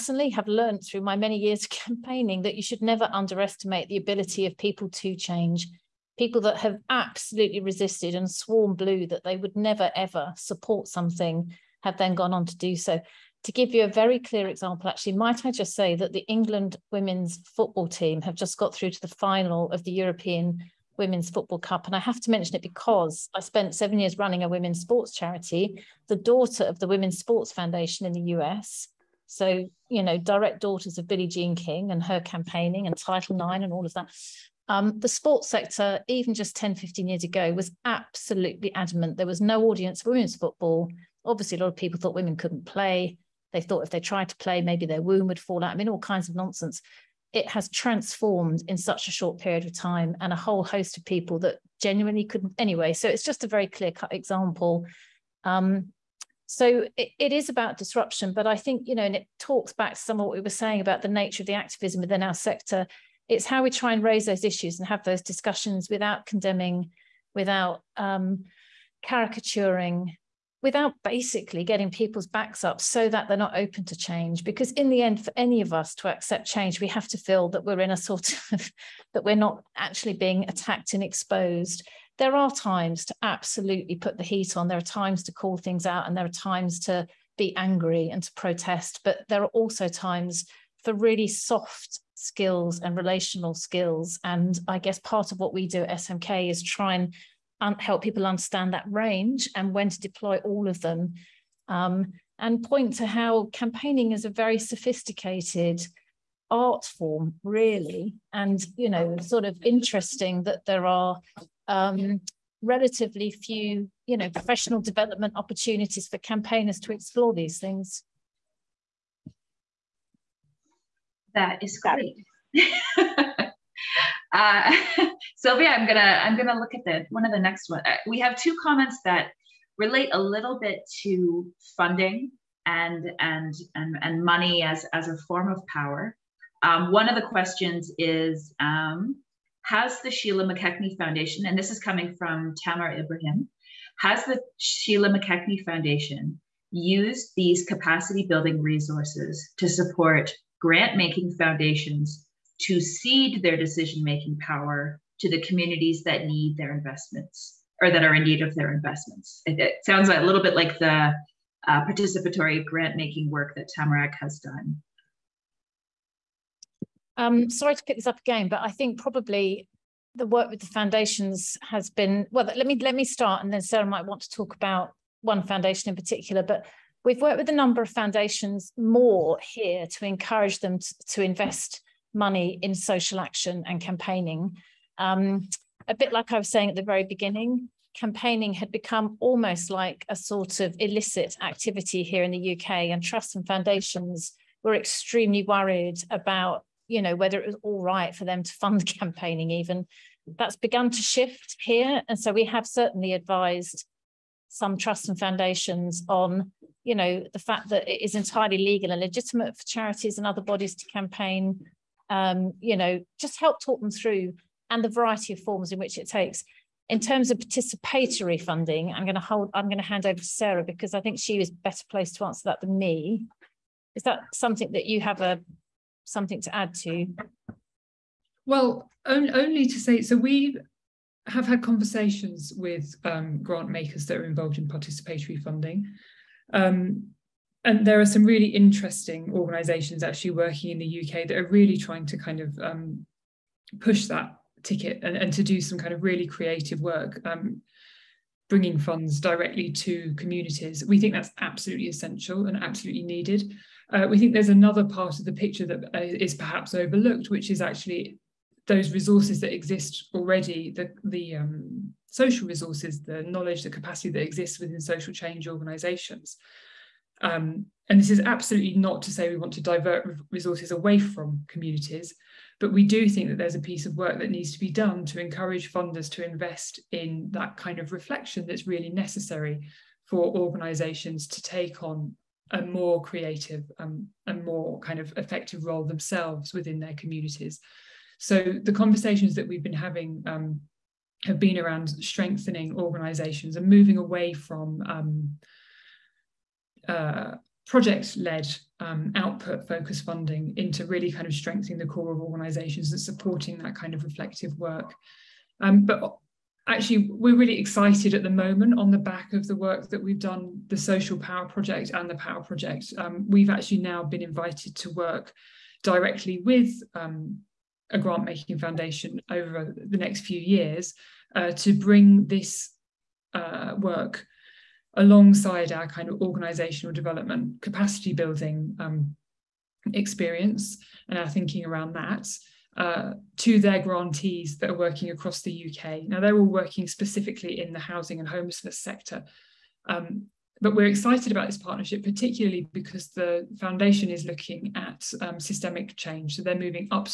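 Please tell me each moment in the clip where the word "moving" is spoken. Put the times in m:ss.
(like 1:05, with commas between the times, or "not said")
4:53, 5:46.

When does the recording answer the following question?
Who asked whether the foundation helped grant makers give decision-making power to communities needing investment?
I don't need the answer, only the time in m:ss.
2:22.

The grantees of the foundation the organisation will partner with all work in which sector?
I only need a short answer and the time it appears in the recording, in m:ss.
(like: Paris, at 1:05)
Housing and homelessness, at 5:37.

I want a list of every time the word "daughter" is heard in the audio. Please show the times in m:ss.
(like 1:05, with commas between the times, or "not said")
0:26, 0:30.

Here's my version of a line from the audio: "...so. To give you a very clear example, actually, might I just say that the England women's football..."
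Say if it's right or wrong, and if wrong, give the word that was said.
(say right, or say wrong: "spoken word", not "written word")
right.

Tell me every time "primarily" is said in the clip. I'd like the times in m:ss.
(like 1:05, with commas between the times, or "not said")
not said.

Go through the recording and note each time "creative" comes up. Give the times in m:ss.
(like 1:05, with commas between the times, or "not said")
4:06, 4:43.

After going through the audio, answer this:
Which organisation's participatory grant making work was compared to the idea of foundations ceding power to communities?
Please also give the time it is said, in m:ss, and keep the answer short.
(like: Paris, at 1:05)
Tamarack, at 2:43.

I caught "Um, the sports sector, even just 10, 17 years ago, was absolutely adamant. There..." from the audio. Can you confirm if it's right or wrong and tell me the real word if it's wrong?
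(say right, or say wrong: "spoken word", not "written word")
wrong: "15", not "17".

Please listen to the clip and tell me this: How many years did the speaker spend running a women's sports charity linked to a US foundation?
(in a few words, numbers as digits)
7.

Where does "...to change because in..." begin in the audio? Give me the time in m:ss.
1:13.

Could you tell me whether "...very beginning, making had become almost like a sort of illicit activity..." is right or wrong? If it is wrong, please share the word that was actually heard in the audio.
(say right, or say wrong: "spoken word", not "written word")
wrong: "campaigning", not "making".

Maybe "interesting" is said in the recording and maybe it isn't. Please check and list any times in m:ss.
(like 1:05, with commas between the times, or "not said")
1:49, 3:58.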